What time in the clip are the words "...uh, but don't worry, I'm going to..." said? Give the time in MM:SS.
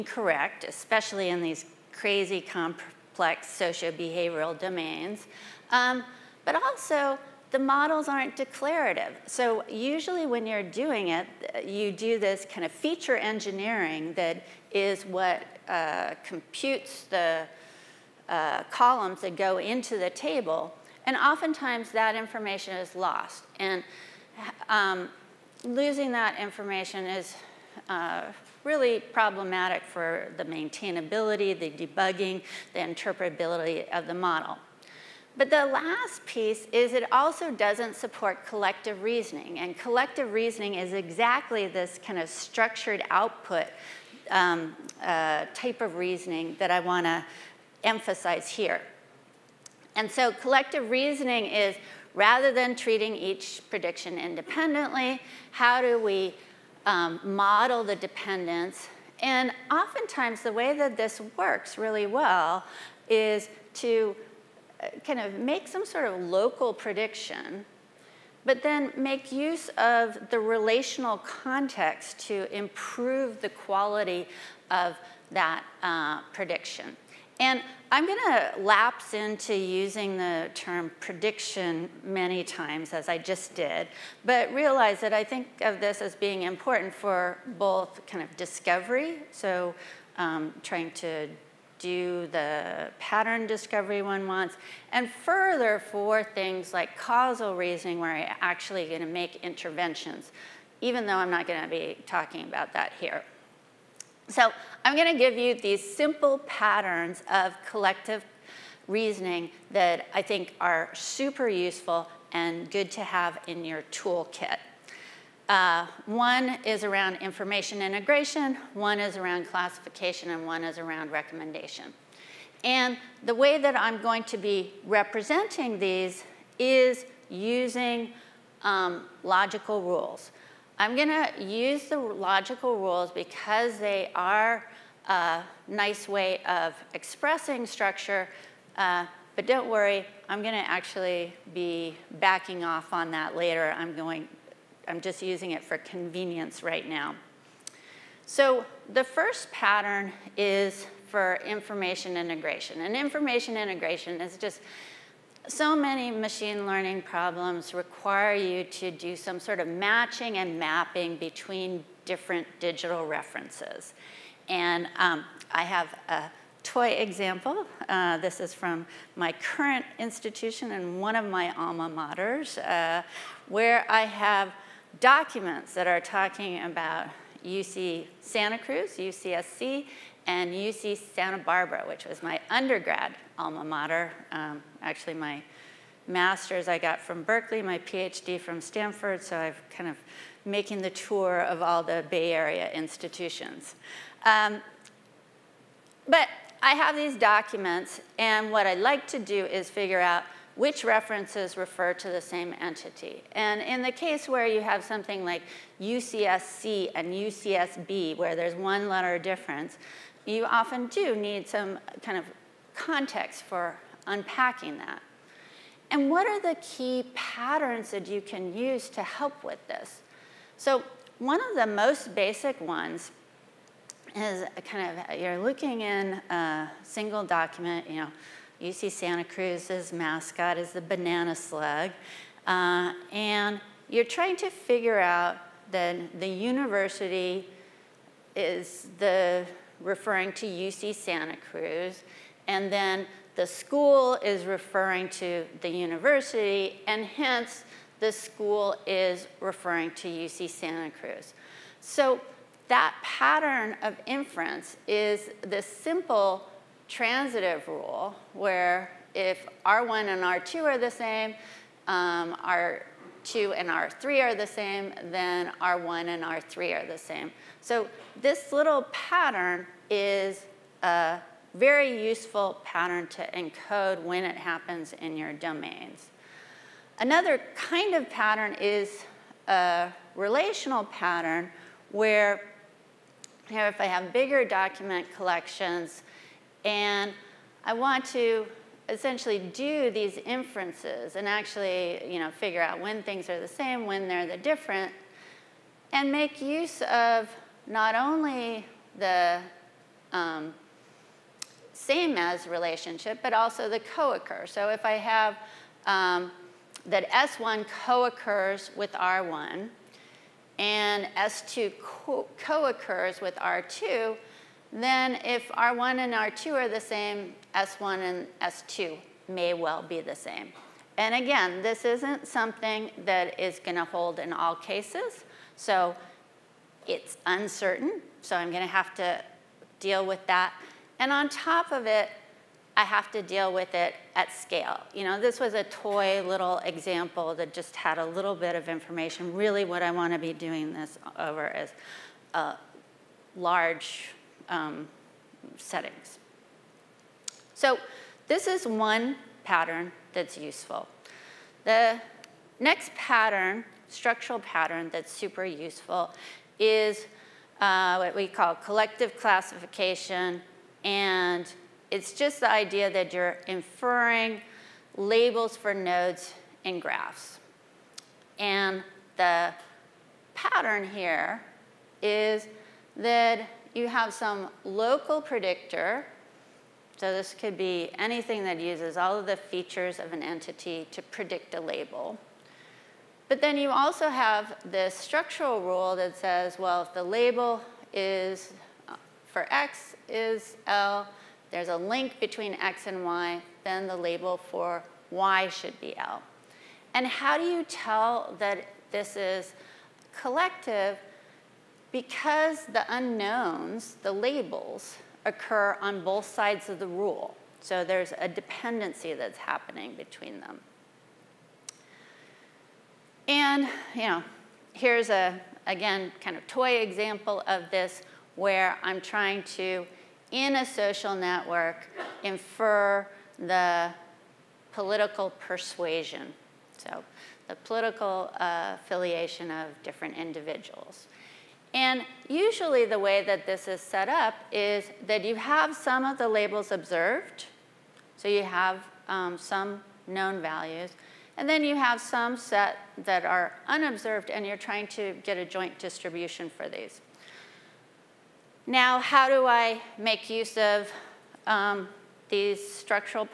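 02:18.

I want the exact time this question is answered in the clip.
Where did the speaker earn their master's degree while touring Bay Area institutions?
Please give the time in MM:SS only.
03:07.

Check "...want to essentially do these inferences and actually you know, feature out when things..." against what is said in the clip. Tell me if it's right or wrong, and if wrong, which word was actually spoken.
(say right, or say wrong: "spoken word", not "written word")
wrong: "figure", not "feature".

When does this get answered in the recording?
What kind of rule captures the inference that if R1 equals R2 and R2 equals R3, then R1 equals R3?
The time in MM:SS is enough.
04:16.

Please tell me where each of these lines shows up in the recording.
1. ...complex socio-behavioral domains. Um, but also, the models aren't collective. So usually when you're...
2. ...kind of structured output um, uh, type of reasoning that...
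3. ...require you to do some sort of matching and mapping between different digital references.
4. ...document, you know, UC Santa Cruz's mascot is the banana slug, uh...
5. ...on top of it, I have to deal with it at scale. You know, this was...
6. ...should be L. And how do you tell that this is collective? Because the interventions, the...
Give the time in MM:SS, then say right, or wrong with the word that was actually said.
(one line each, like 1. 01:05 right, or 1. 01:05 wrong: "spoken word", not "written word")
1. 00:02 wrong: "declarative", not "collective"
2. 00:42 right
3. 02:37 right
4. 03:47 right
5. 05:31 right
6. 06:35 wrong: "unknowns", not "interventions".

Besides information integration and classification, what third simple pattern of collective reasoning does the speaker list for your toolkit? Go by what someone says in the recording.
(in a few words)
recommendation.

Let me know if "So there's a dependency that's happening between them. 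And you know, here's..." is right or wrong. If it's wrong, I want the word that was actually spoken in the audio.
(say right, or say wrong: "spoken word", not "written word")
right.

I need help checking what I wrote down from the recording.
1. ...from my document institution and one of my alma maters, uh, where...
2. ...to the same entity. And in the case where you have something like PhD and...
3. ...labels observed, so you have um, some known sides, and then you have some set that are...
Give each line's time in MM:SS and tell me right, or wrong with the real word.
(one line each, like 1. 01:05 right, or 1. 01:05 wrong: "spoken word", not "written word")
1. 02:48 wrong: "current", not "document"
2. 03:21 wrong: "UCSC", not "PhD"
3. 07:16 wrong: "values", not "sides".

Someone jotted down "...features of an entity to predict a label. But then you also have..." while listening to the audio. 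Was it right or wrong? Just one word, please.
right.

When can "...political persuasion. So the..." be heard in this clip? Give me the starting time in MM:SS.
07:04.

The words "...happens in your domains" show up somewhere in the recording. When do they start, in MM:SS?
04:34.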